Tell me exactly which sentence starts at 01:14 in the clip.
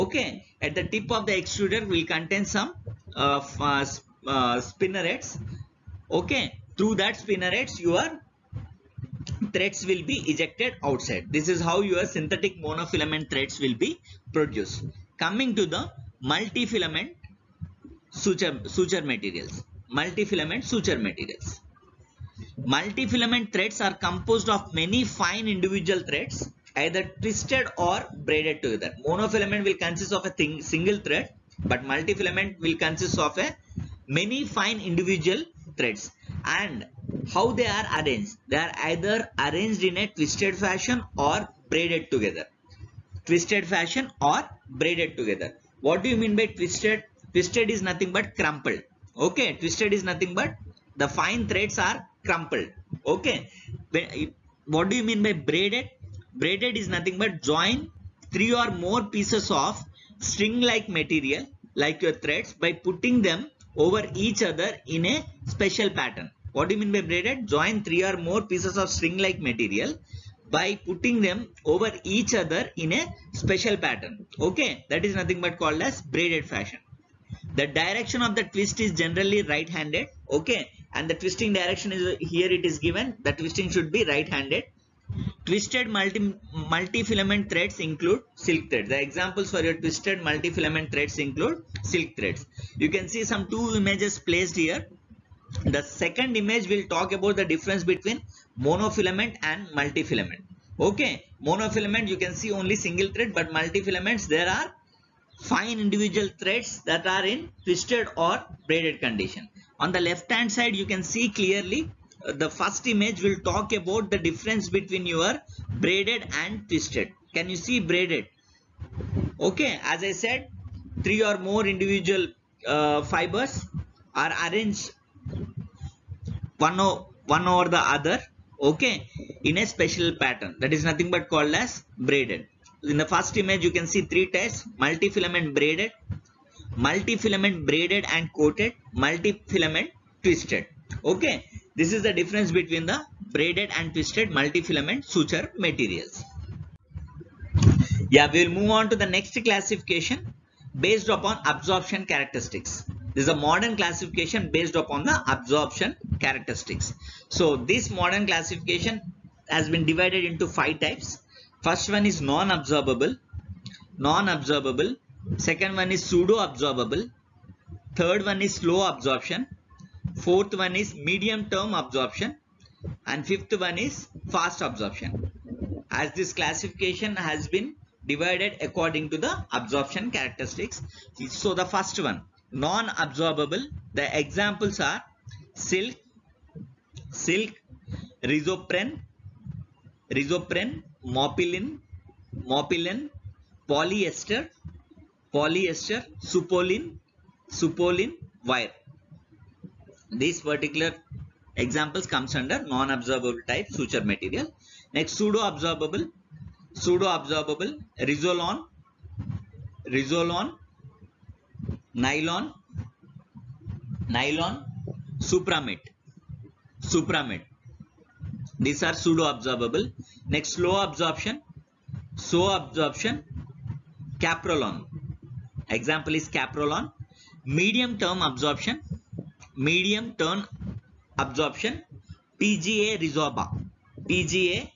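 Okay, that is nothing but called as braided fashion.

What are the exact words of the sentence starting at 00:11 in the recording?
This is how your synthetic monofilament threads will be produced.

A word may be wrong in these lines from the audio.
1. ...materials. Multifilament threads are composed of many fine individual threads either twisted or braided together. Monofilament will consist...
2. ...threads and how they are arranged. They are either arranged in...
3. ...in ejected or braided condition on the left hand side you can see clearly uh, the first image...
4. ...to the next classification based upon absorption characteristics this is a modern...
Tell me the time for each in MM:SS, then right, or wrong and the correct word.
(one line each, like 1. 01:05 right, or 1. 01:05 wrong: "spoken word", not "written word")
1. 00:20 right
2. 00:35 right
3. 01:47 wrong: "twisted", not "ejected"
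4. 02:28 right.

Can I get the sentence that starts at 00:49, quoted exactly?
Okay, twisted is nothing but the fine threads are crumpled.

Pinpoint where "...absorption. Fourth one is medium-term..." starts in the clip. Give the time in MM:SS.
02:48.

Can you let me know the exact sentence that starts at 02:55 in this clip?
As this classification has been divided according to the absorption characteristics.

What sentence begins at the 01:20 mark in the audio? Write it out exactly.
Okay, and the twisting direction is here it is given.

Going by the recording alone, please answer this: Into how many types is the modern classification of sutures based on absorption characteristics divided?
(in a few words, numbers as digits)
5.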